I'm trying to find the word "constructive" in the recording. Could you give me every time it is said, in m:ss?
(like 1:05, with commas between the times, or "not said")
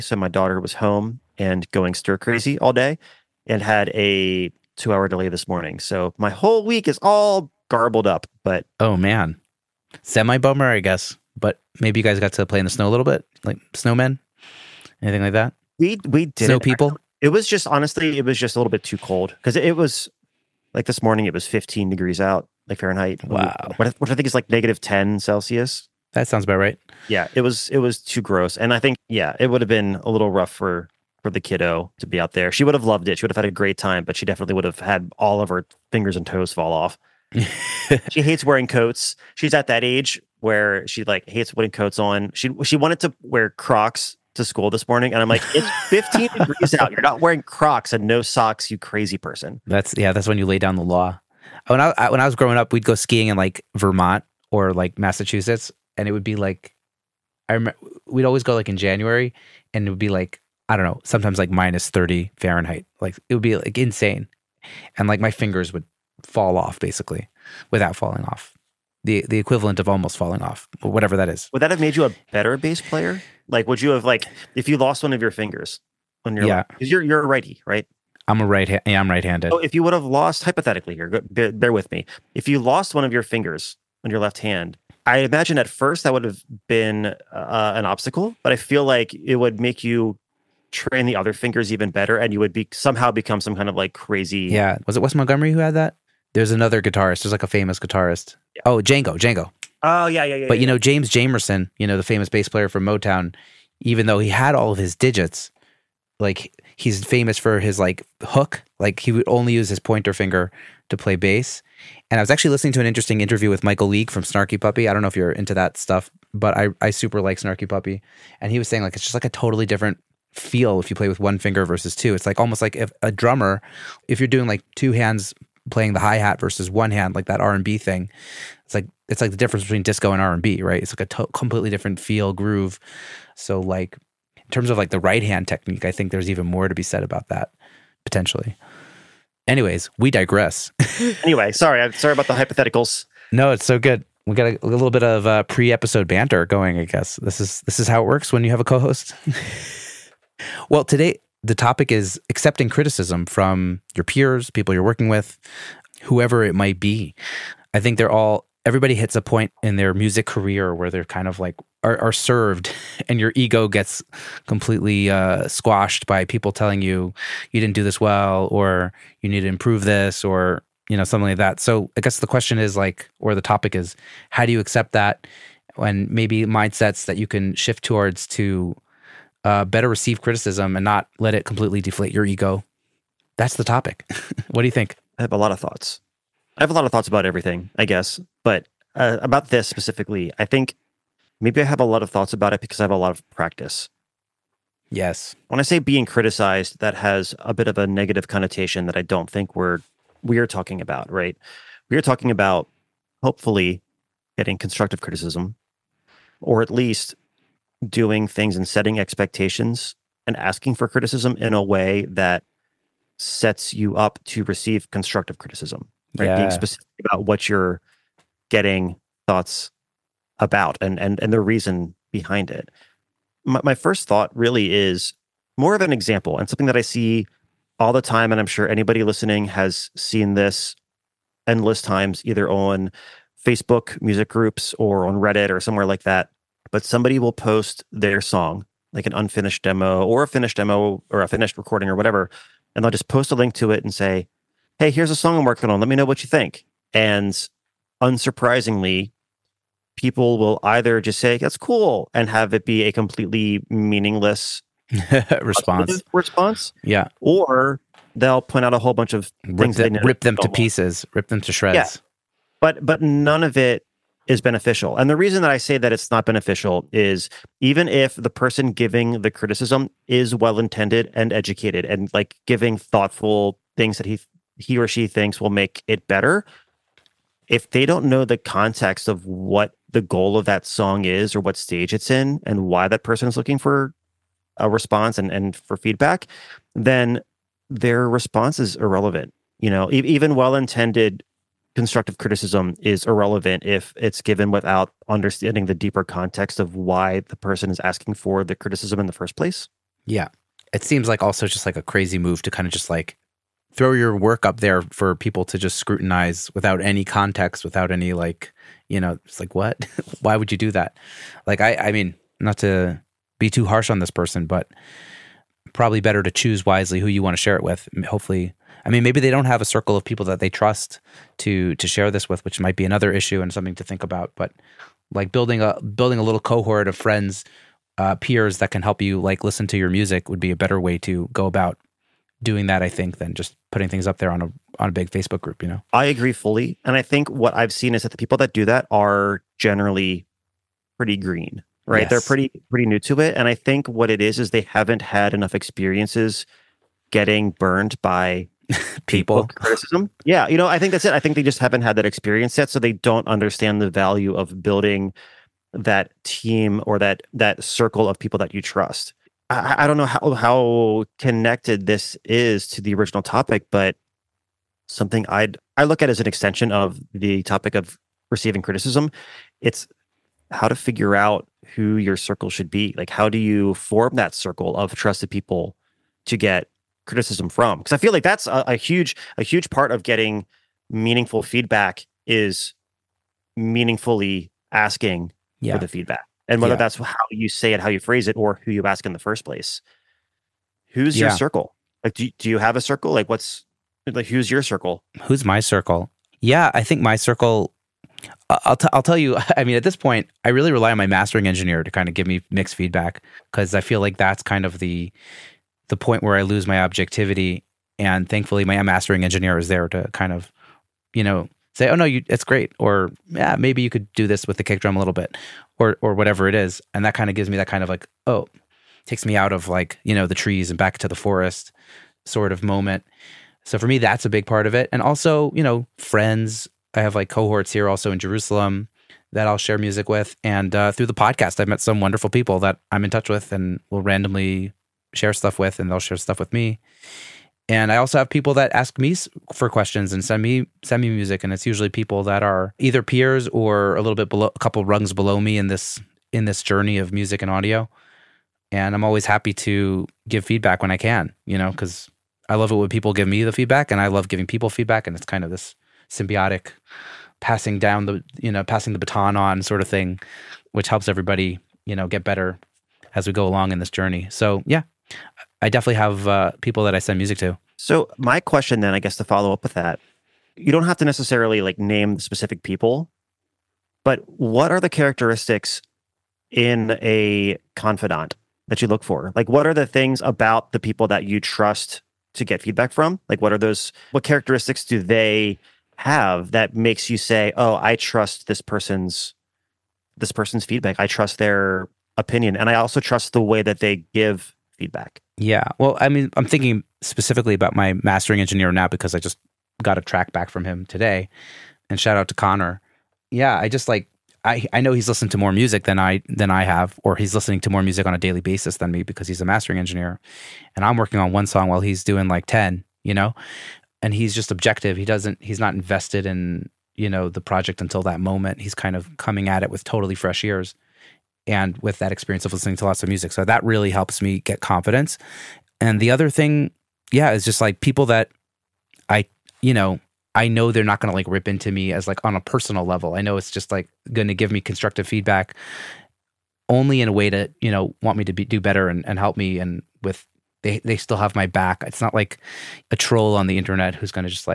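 3:24, 3:34, 4:51, 8:54.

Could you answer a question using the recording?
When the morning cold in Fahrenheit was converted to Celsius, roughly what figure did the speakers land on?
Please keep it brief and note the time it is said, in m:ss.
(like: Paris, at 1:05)
-10 Celsius, at 0:24.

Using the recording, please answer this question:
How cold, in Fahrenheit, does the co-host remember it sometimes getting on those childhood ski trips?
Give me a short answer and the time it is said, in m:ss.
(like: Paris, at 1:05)
-30 Fahrenheit, at 1:01.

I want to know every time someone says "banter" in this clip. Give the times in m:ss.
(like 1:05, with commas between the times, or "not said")
2:26.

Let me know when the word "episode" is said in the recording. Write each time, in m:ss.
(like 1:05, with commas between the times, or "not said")
2:25.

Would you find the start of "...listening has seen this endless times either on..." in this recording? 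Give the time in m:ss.
3:49.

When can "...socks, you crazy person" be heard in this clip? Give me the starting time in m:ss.
0:48.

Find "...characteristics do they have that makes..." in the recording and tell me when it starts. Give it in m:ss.
8:04.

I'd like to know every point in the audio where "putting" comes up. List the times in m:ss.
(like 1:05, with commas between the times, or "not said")
0:41, 5:33.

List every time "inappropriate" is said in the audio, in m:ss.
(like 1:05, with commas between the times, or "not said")
not said.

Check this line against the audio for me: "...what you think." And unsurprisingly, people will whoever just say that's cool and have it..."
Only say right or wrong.
wrong.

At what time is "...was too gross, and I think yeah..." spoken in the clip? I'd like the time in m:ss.
0:27.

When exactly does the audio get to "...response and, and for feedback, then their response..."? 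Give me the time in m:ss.
4:44.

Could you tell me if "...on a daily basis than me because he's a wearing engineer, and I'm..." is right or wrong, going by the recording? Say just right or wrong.
wrong.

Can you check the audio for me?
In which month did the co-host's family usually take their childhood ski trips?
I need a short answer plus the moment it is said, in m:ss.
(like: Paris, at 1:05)
January, at 0:58.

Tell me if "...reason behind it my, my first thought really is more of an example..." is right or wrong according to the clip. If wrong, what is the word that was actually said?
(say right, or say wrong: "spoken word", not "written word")
right.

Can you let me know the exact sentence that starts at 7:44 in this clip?
So yeah, I definitely have uh, people that I send music to.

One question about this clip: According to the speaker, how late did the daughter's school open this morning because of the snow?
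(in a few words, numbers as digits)
2 hours.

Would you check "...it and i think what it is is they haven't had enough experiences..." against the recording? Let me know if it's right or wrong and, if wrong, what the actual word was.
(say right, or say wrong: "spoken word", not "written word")
right.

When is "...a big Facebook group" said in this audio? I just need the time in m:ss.
5:34.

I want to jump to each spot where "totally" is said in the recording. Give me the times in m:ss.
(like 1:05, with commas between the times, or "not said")
1:59, 8:39.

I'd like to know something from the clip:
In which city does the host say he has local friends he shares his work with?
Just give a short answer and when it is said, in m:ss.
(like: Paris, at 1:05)
Jerusalem, at 7:08.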